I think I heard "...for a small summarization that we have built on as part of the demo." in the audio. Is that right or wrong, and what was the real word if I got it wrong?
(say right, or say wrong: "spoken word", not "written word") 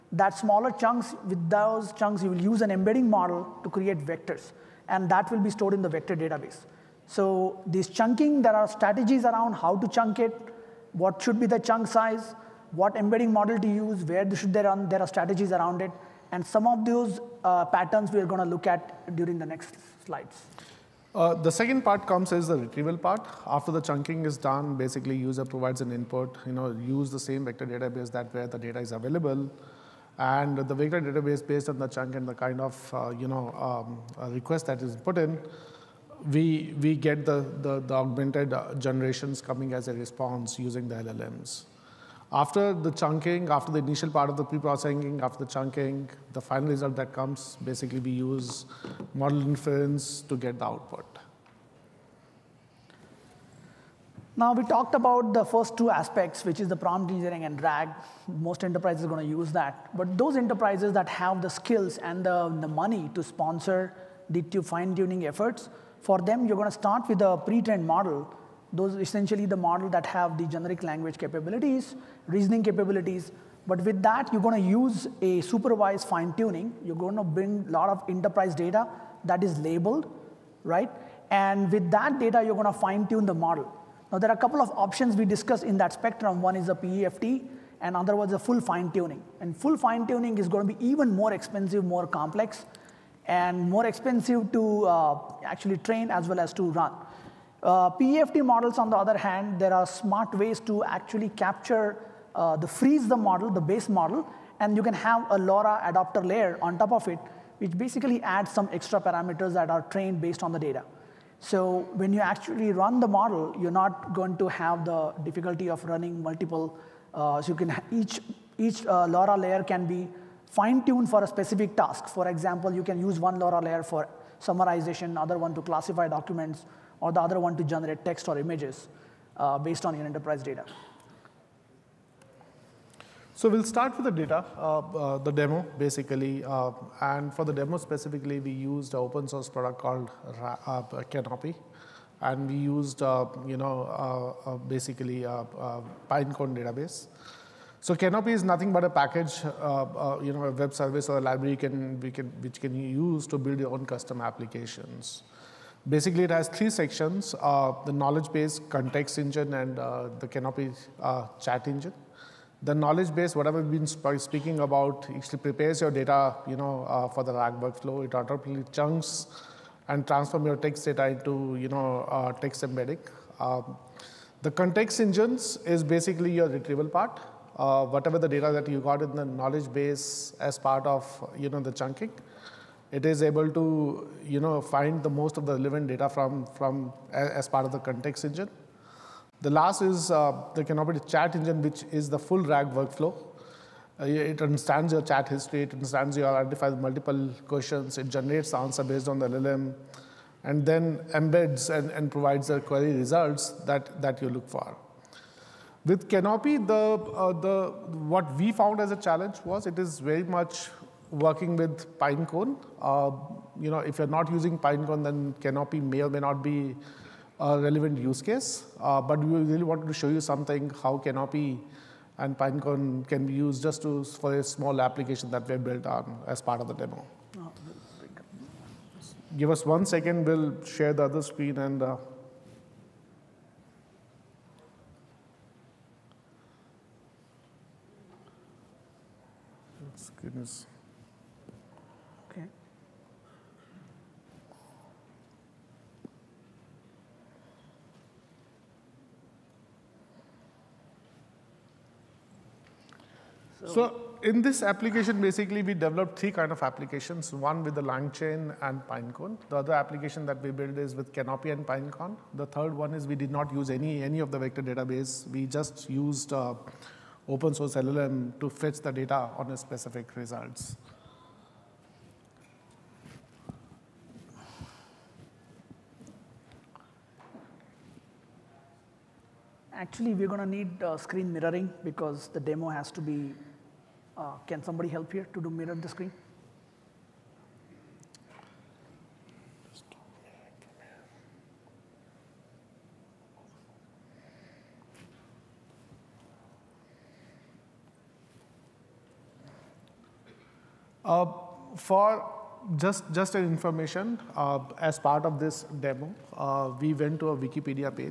wrong: "application", not "summarization".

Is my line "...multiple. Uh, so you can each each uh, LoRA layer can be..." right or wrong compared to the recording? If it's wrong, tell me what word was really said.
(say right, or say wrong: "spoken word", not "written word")
right.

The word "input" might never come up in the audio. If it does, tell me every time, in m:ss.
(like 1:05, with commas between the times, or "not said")
0:25.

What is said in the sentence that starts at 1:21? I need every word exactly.
And with that data, you're going to fine tune the model.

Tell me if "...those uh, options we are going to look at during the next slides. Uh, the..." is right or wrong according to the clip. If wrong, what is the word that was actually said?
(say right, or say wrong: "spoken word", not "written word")
wrong: "patterns", not "options".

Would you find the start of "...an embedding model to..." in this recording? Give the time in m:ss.
0:02.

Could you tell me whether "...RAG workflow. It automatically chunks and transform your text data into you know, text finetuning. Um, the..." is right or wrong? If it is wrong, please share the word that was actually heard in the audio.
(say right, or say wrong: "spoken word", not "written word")
wrong: "embedding", not "finetuning".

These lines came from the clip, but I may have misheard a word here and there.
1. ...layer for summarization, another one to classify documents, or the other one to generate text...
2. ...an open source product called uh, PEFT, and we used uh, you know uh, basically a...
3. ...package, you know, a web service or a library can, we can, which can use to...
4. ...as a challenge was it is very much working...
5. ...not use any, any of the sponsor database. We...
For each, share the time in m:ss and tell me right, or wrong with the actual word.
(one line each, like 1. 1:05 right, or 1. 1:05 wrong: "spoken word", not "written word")
1. 2:03 right
2. 2:18 wrong: "Canopy", not "PEFT"
3. 2:28 right
4. 3:28 right
5. 4:23 wrong: "vector", not "sponsor".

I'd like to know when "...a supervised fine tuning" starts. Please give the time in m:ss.
1:15.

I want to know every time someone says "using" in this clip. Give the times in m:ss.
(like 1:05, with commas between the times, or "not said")
0:40, 3:34.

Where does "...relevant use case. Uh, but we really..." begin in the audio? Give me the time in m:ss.
3:37.